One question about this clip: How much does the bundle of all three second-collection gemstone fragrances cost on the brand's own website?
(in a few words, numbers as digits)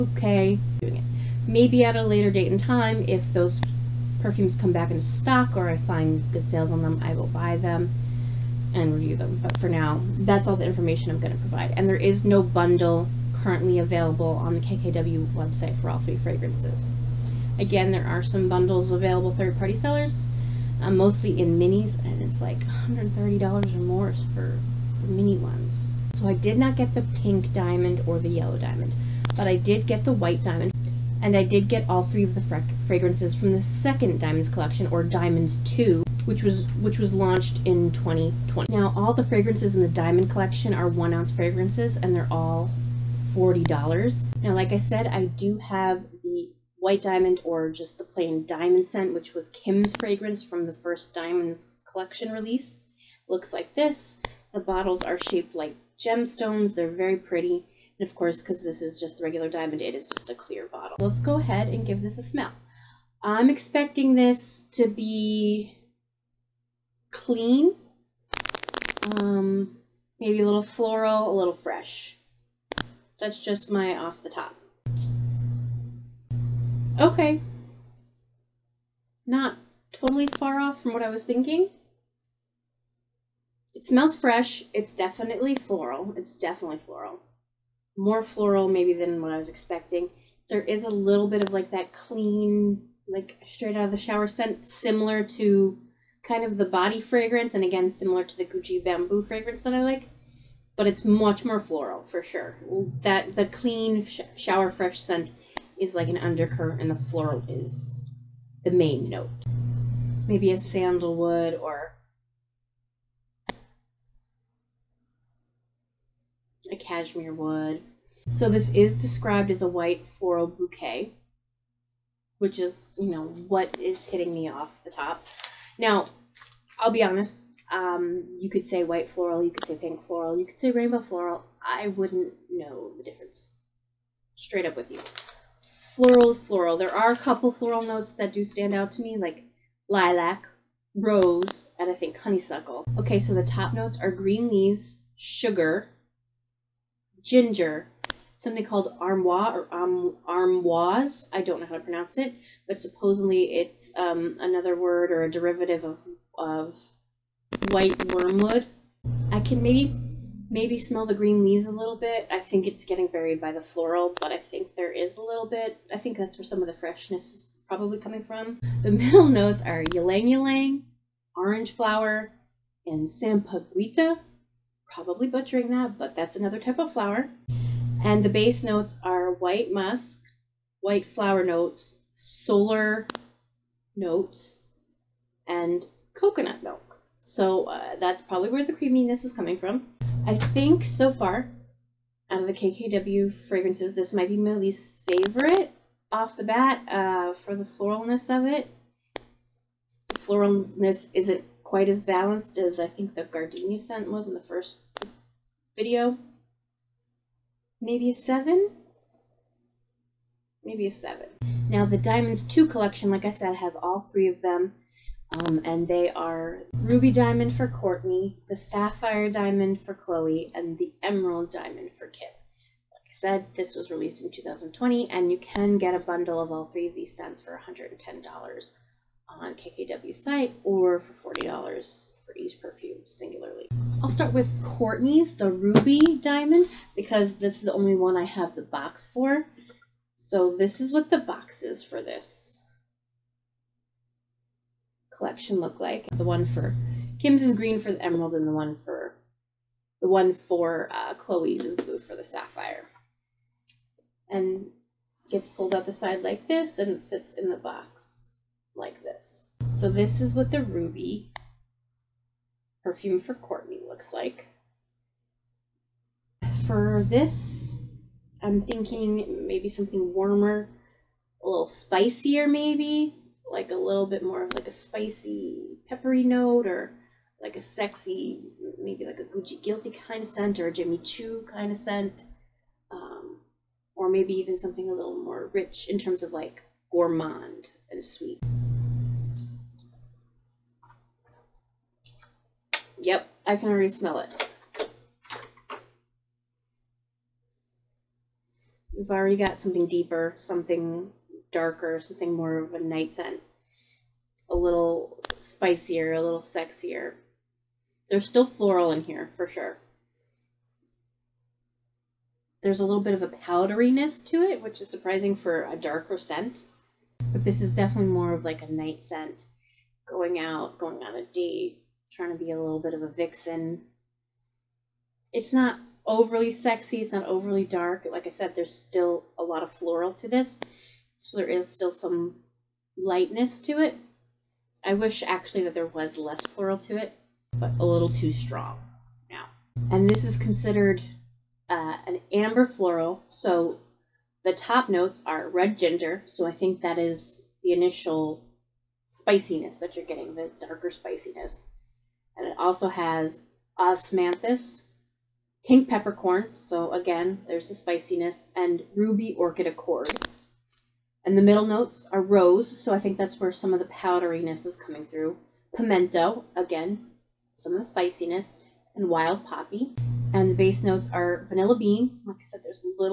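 $110.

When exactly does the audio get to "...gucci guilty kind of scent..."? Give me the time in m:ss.
4:39.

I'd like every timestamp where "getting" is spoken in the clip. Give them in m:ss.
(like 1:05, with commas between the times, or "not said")
2:42, 5:50.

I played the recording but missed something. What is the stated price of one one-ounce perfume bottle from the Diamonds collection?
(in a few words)
$40.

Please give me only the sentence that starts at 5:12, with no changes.
There's a little bit of a powderiness to it, which is surprising for a darker scent.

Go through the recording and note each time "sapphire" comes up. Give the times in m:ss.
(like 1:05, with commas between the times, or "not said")
3:38, 4:12.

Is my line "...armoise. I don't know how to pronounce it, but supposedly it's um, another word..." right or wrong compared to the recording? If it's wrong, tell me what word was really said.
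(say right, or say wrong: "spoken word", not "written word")
right.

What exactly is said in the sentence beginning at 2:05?
Now, I'll be honest, um, you could say white floral, you could say pink floral, you could say rainbow floral.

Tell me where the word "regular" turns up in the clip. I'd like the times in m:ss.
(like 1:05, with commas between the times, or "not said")
0:59.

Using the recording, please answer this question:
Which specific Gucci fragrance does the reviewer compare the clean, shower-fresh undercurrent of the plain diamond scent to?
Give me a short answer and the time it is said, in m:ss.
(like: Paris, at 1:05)
Gucci bamboo, at 1:38.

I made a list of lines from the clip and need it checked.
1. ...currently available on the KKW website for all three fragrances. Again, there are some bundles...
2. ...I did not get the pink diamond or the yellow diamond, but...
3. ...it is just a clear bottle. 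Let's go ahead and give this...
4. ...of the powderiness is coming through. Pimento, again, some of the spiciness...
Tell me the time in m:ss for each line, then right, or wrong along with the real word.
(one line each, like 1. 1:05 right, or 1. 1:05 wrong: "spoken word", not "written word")
1. 0:13 right
2. 0:26 right
3. 0:59 right
4. 6:03 right.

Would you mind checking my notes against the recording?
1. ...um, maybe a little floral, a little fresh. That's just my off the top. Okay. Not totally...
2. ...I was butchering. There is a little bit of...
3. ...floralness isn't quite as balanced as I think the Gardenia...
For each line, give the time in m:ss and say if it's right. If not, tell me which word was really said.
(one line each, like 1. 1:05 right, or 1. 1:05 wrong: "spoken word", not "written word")
1. 1:09 right
2. 1:29 wrong: "expecting", not "butchering"
3. 3:20 right.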